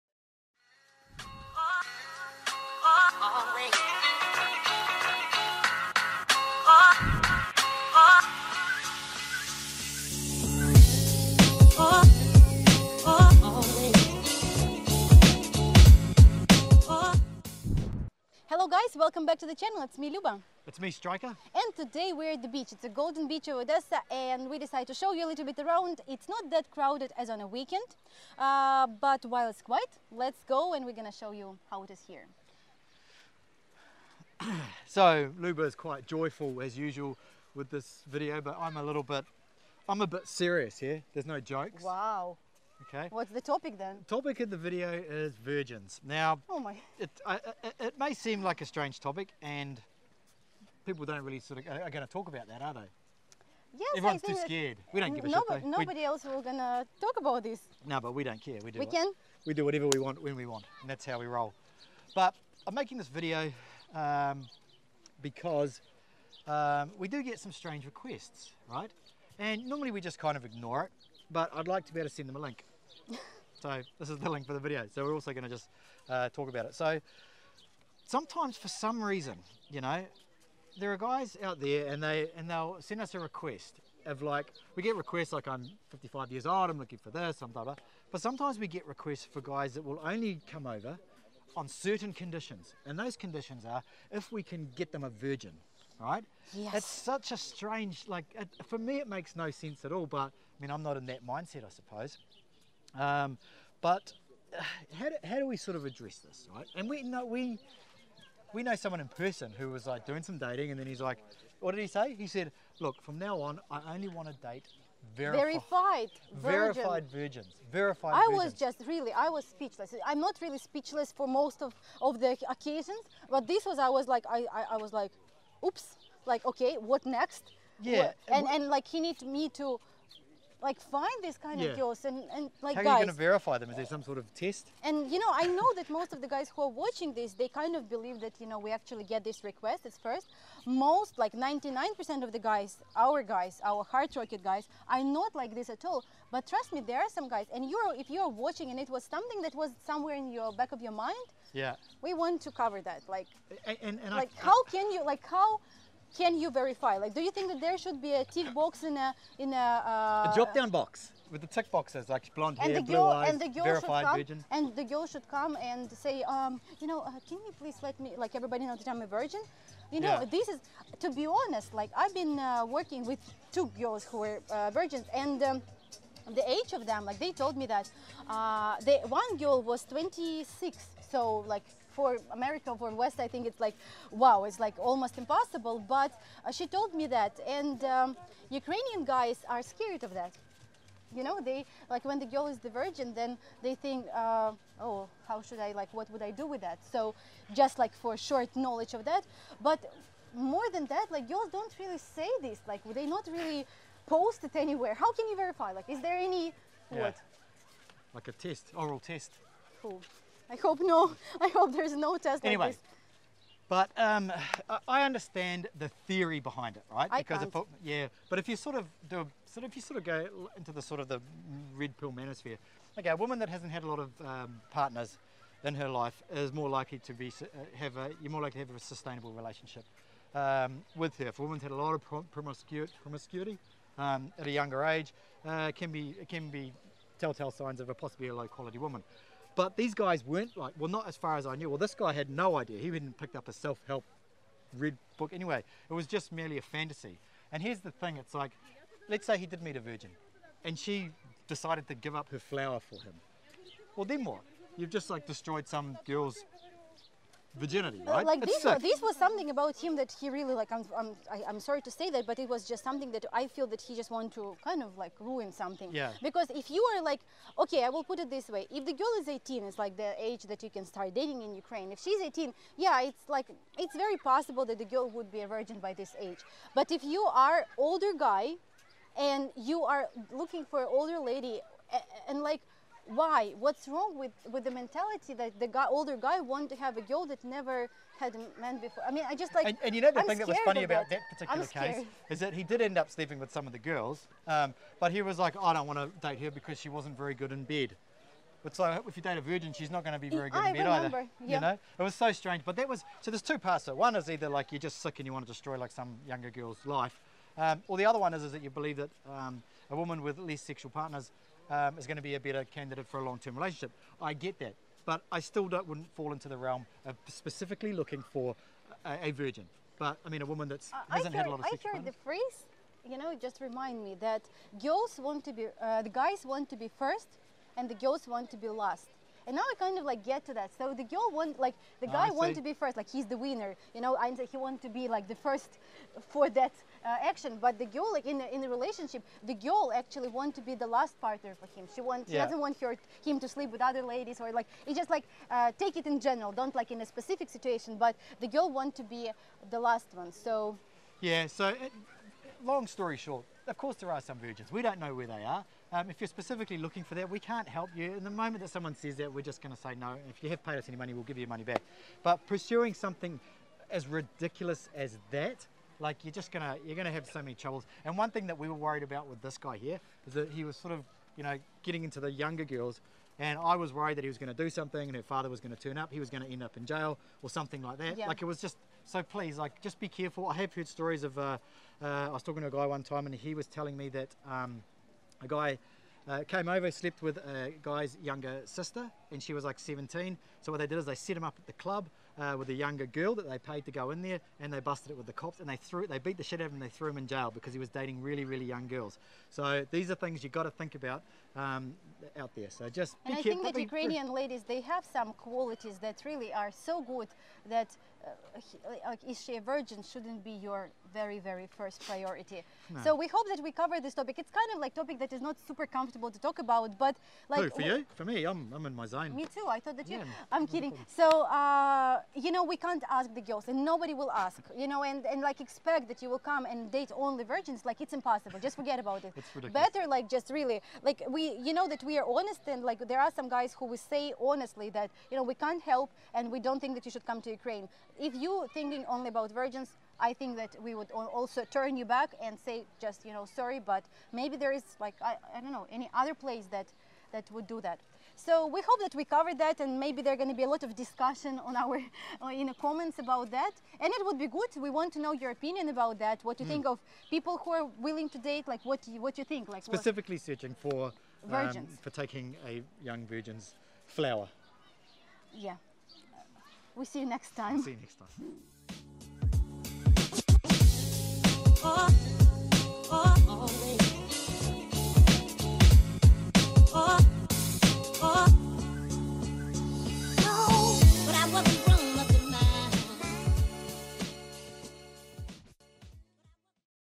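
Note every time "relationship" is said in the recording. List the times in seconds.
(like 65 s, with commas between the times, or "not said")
229 s, 313 s, 338 s.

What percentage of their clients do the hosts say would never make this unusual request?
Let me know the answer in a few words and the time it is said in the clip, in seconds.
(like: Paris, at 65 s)
99%, at 141 s.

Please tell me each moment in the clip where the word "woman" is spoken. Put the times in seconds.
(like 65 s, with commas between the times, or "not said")
223 s, 231 s, 238 s, 309 s, 320 s.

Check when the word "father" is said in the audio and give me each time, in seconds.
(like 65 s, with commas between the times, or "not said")
375 s.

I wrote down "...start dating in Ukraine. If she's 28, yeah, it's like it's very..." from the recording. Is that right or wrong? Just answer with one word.
wrong.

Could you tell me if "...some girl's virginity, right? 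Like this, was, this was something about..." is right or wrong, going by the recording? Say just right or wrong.
right.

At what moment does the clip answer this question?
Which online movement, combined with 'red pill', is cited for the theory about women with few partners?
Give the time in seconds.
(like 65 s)
222 s.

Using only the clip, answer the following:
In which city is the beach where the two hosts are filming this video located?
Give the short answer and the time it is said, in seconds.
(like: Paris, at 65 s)
Odessa, at 23 s.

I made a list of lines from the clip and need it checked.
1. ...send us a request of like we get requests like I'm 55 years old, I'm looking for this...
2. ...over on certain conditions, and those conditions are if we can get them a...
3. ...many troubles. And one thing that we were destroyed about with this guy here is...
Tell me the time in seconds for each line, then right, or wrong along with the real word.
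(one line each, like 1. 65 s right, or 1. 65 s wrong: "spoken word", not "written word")
1. 82 s right
2. 90 s right
3. 367 s wrong: "worried", not "destroyed".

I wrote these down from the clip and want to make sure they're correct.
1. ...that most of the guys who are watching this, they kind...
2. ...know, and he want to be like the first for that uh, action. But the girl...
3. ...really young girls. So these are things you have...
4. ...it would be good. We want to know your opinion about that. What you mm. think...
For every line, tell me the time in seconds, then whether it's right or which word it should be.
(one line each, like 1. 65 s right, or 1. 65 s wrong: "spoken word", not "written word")
1. 135 s right
2. 334 s right
3. 398 s right
4. 454 s right.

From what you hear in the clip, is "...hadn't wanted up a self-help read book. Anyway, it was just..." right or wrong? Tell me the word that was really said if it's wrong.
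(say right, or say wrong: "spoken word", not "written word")
wrong: "picked", not "wanted".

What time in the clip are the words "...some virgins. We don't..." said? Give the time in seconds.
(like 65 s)
354 s.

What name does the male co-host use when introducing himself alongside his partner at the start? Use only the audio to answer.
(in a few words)
Striker.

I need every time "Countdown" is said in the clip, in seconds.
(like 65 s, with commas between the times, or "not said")
not said.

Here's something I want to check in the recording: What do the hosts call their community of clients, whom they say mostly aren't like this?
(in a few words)
Heart Rocket.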